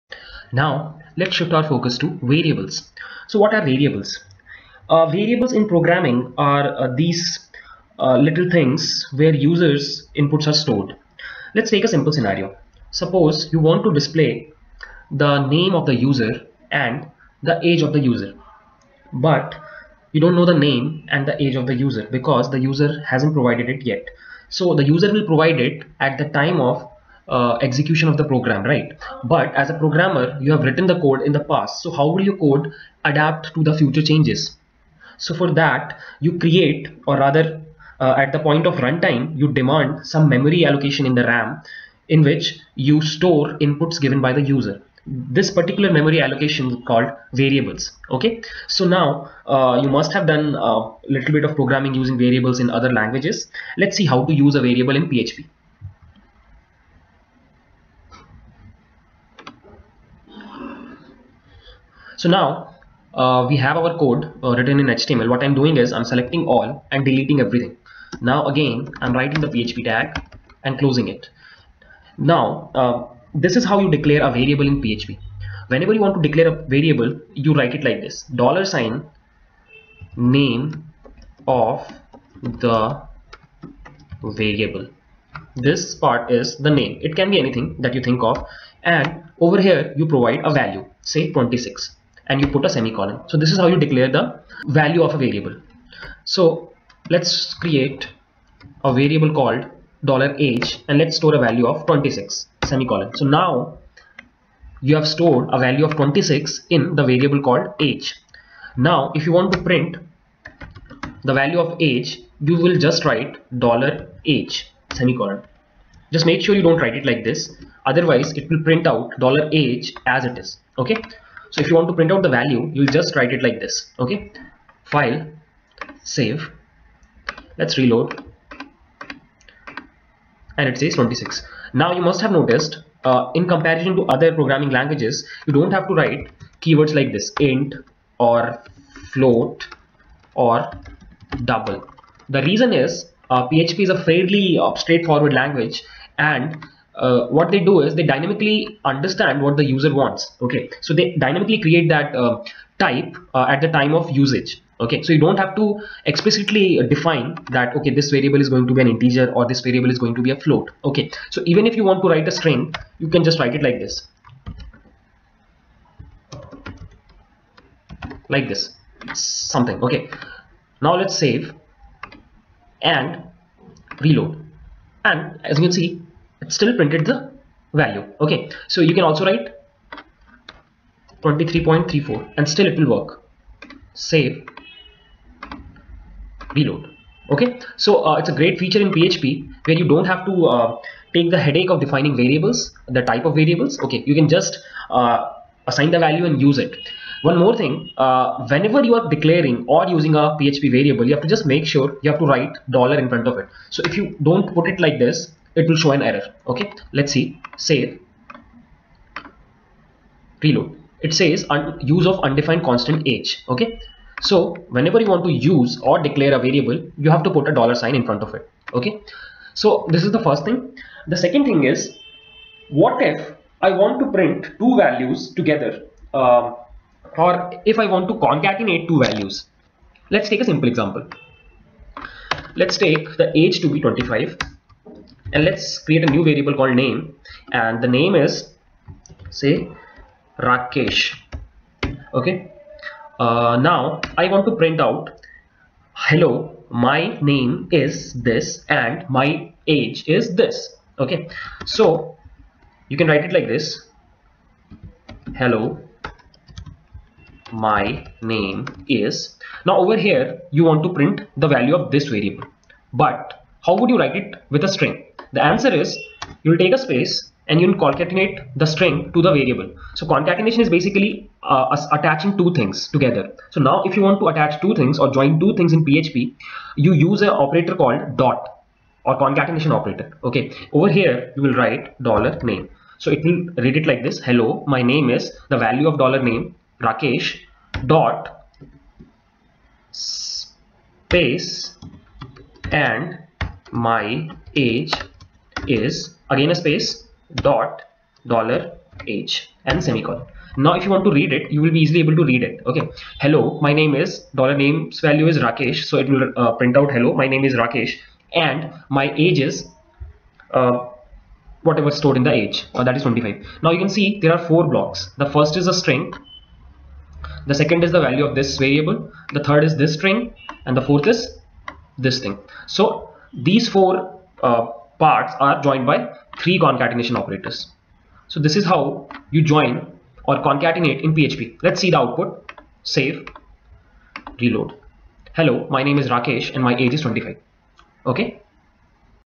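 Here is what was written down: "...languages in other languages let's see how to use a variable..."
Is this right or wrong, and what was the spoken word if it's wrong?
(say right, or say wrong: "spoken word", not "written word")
wrong: "variables", not "languages".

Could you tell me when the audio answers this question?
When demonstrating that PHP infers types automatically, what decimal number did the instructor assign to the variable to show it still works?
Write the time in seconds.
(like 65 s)
181 s.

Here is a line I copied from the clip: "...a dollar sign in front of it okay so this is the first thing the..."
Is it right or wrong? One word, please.
right.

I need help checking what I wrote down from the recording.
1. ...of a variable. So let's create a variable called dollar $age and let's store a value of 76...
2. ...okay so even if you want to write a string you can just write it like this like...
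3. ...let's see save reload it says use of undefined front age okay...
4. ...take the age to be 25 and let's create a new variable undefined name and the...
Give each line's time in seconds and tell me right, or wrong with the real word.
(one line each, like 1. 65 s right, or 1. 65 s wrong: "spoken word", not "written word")
1. 95 s wrong: "26", not "76"
2. 160 s right
3. 206 s wrong: "constant", not "front"
4. 232 s wrong: "called", not "undefined".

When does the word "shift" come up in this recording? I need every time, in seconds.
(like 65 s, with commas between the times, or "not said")
1 s.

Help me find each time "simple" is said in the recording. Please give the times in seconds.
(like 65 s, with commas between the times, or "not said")
11 s, 230 s.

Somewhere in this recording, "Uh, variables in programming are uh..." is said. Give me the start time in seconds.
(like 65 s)
4 s.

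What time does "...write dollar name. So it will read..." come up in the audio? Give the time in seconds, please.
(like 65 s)
281 s.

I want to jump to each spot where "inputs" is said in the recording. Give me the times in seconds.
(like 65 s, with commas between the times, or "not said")
10 s, 43 s.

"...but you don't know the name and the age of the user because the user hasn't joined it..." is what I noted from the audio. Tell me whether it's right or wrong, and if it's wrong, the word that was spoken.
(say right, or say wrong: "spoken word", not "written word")
wrong: "provided", not "joined".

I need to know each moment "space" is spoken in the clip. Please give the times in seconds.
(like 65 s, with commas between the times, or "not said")
266 s, 289 s, 296 s.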